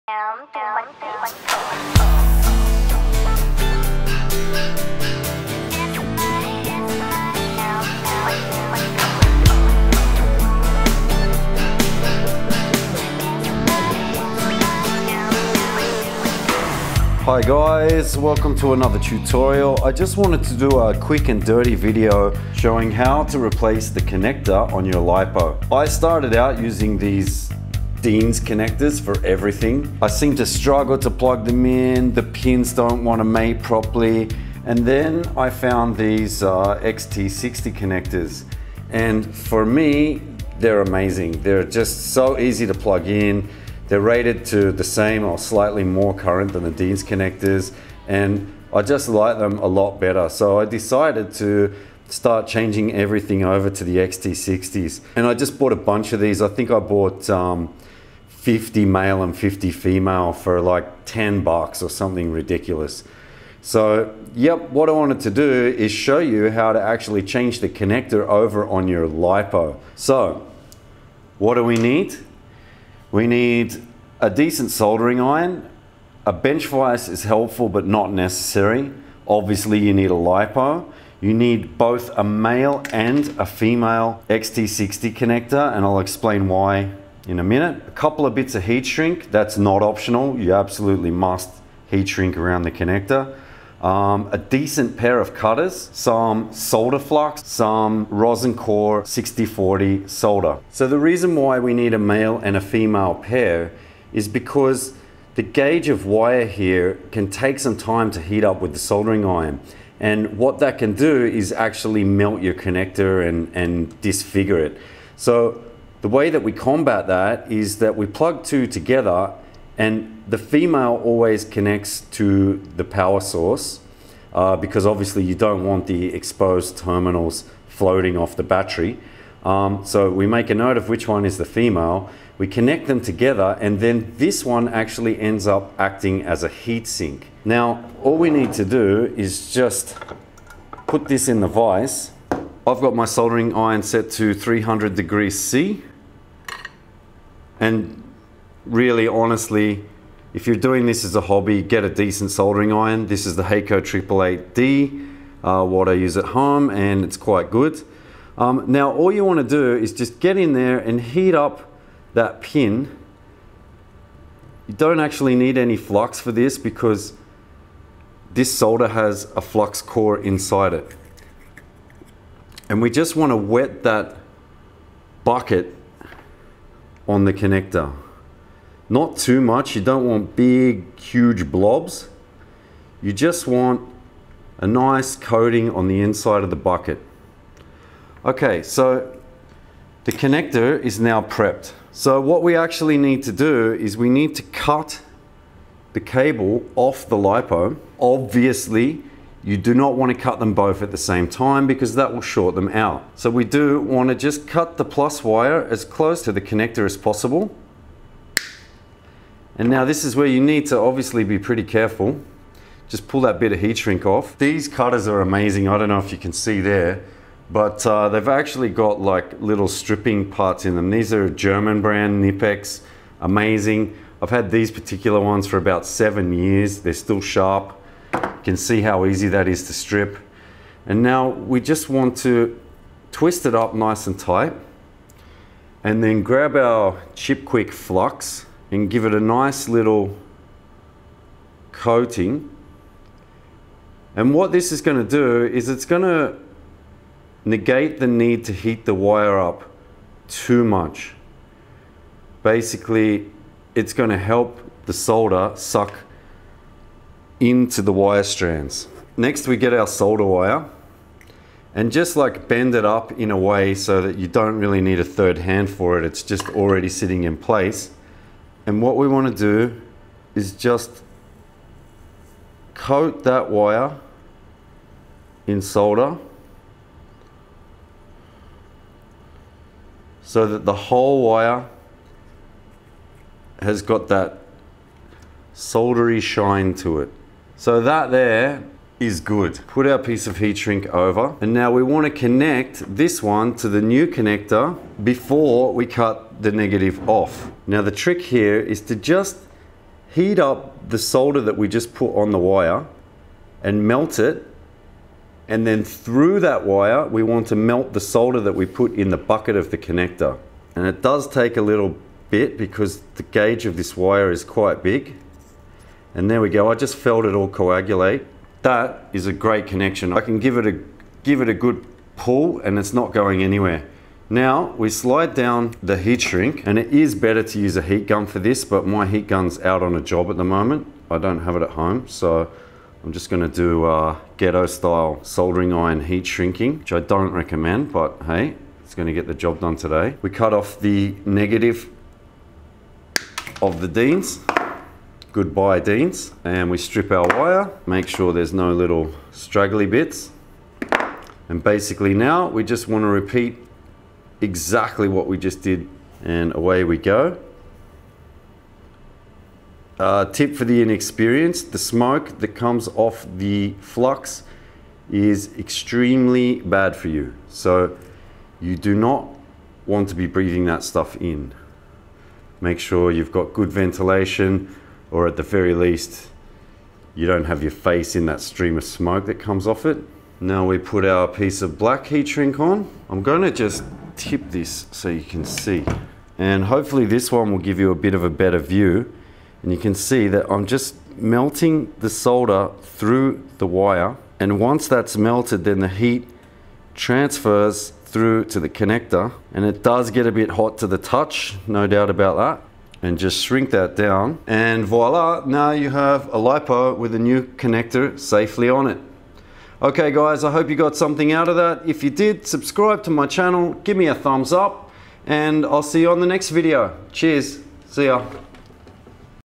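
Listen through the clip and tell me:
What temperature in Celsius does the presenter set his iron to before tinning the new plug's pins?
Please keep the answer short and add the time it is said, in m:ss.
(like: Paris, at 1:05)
300 degrees C, at 2:24.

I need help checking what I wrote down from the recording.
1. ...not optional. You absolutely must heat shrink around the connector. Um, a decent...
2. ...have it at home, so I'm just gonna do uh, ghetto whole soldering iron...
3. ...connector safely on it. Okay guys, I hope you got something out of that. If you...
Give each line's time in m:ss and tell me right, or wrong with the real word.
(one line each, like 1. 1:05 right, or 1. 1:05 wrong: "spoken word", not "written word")
1. 1:29 right
2. 5:31 wrong: "style", not "whole"
3. 6:47 right.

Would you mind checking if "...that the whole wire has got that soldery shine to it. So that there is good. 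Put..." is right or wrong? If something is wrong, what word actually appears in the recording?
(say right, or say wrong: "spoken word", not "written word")
right.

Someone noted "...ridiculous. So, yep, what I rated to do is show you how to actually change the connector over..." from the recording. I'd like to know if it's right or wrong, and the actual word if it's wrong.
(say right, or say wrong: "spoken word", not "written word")
wrong: "wanted", not "rated".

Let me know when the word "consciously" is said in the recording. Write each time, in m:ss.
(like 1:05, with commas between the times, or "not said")
not said.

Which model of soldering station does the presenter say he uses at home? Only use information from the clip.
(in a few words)
Hakko 888D.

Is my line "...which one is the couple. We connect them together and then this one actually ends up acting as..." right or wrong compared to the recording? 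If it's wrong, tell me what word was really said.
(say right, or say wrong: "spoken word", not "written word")
wrong: "female", not "couple".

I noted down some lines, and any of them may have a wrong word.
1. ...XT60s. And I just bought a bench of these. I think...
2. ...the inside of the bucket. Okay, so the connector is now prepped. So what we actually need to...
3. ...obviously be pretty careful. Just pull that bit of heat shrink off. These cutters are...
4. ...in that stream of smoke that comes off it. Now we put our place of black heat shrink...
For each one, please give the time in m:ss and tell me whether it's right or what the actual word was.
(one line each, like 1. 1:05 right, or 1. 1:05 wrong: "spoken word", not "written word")
1. 0:53 wrong: "bunch", not "bench"
2. 3:05 right
3. 3:30 right
4. 6:18 wrong: "piece", not "place".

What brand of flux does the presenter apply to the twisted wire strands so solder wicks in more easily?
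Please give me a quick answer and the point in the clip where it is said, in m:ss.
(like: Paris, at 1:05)
ChipQuik, at 3:57.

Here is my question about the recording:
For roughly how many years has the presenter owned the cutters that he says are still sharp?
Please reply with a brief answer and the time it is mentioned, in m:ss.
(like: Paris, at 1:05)
7, at 3:45.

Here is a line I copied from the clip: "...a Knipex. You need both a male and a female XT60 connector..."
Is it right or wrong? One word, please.
wrong.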